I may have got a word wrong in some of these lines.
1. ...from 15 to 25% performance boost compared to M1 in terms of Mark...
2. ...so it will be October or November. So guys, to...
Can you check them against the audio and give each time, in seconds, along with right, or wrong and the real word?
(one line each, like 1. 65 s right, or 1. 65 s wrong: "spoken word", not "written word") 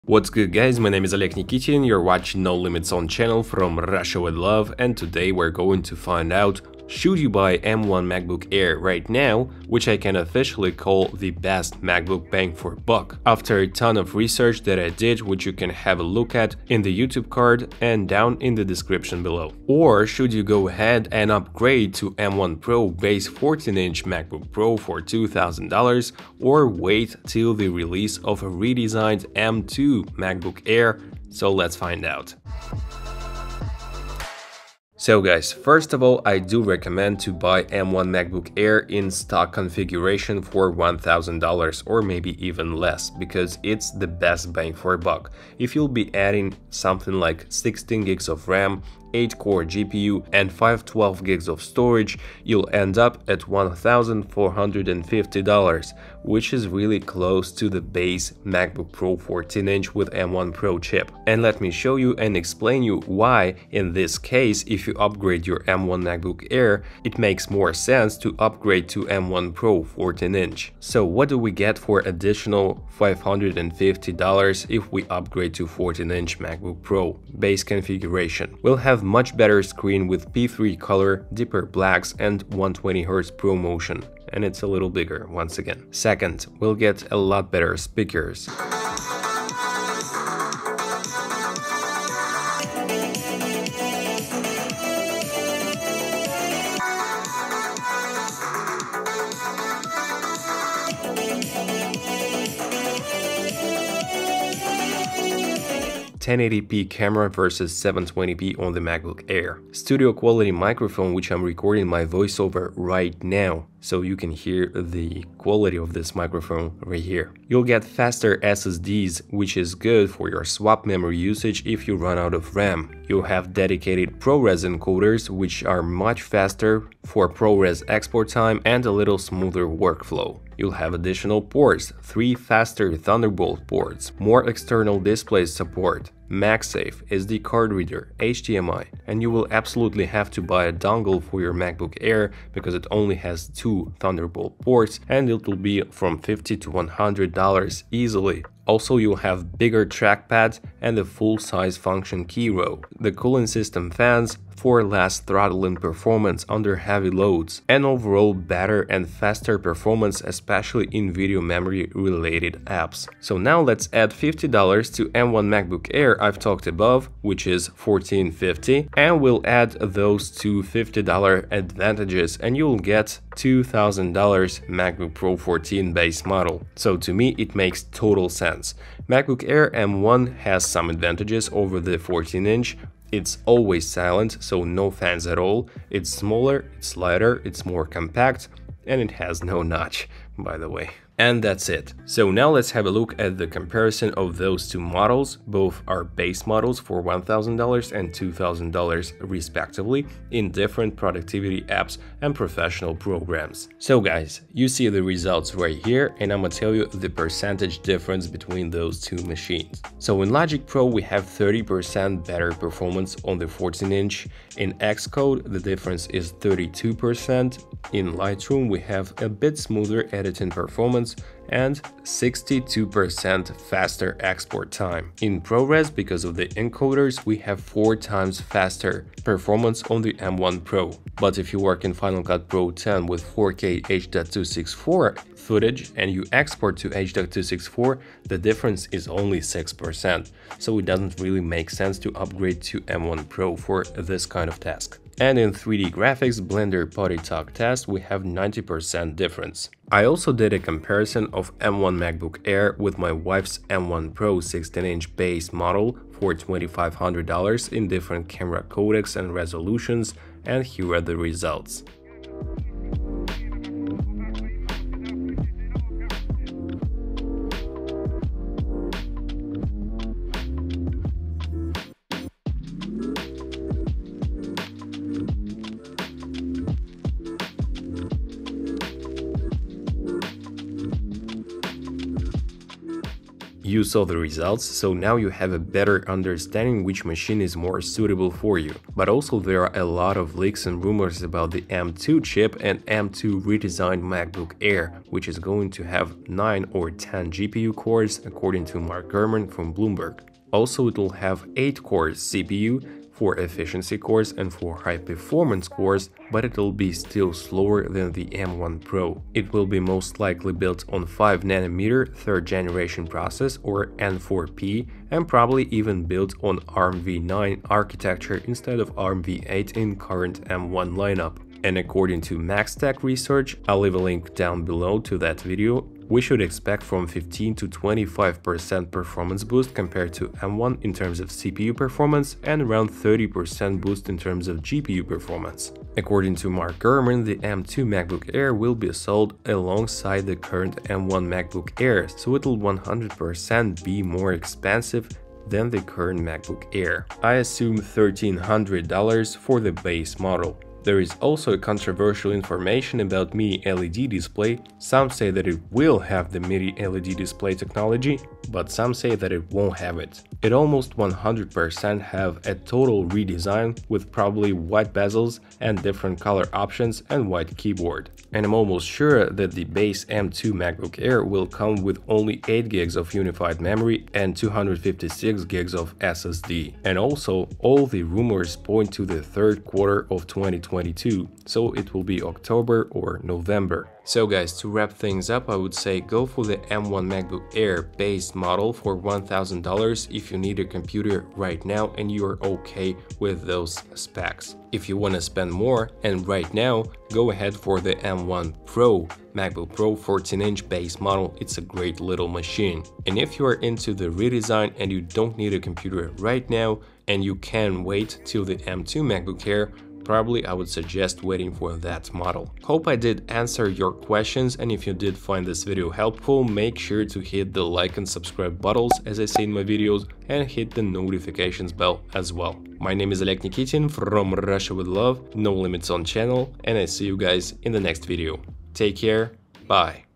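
1. 326 s wrong: "CPU", not "Mark"
2. 381 s right.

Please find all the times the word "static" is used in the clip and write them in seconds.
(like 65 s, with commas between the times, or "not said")
not said.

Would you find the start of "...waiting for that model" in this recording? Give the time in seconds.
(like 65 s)
411 s.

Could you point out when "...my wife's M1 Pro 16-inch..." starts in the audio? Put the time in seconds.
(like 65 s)
252 s.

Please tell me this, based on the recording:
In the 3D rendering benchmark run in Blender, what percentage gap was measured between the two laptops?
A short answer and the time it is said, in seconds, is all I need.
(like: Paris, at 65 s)
90%, at 248 s.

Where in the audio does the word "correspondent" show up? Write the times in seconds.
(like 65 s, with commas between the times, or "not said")
not said.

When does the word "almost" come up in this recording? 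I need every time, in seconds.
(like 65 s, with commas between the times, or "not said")
360 s, 368 s.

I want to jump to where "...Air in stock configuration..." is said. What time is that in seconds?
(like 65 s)
38 s.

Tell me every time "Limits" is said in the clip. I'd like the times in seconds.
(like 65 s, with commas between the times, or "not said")
2 s, 425 s.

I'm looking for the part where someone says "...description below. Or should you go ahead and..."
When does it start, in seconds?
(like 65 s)
18 s.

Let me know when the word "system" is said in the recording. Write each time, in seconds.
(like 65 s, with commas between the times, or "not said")
153 s.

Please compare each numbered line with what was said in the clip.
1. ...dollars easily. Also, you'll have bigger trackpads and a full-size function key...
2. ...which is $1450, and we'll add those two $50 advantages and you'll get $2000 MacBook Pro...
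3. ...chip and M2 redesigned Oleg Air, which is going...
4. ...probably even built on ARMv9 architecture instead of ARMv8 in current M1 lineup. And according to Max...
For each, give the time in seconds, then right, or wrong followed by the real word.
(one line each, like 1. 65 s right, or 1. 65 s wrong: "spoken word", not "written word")
1. 147 s right
2. 167 s right
3. 292 s wrong: "MacBook", not "Oleg"
4. 315 s right.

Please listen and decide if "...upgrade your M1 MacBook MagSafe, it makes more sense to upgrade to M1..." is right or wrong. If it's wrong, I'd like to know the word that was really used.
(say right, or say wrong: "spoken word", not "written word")
wrong: "Air", not "MagSafe".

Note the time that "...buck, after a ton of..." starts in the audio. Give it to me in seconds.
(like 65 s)
12 s.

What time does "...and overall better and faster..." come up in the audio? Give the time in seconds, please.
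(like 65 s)
157 s.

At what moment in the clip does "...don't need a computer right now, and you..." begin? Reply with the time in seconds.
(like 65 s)
405 s.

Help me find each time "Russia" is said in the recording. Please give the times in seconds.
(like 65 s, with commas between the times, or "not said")
3 s, 424 s.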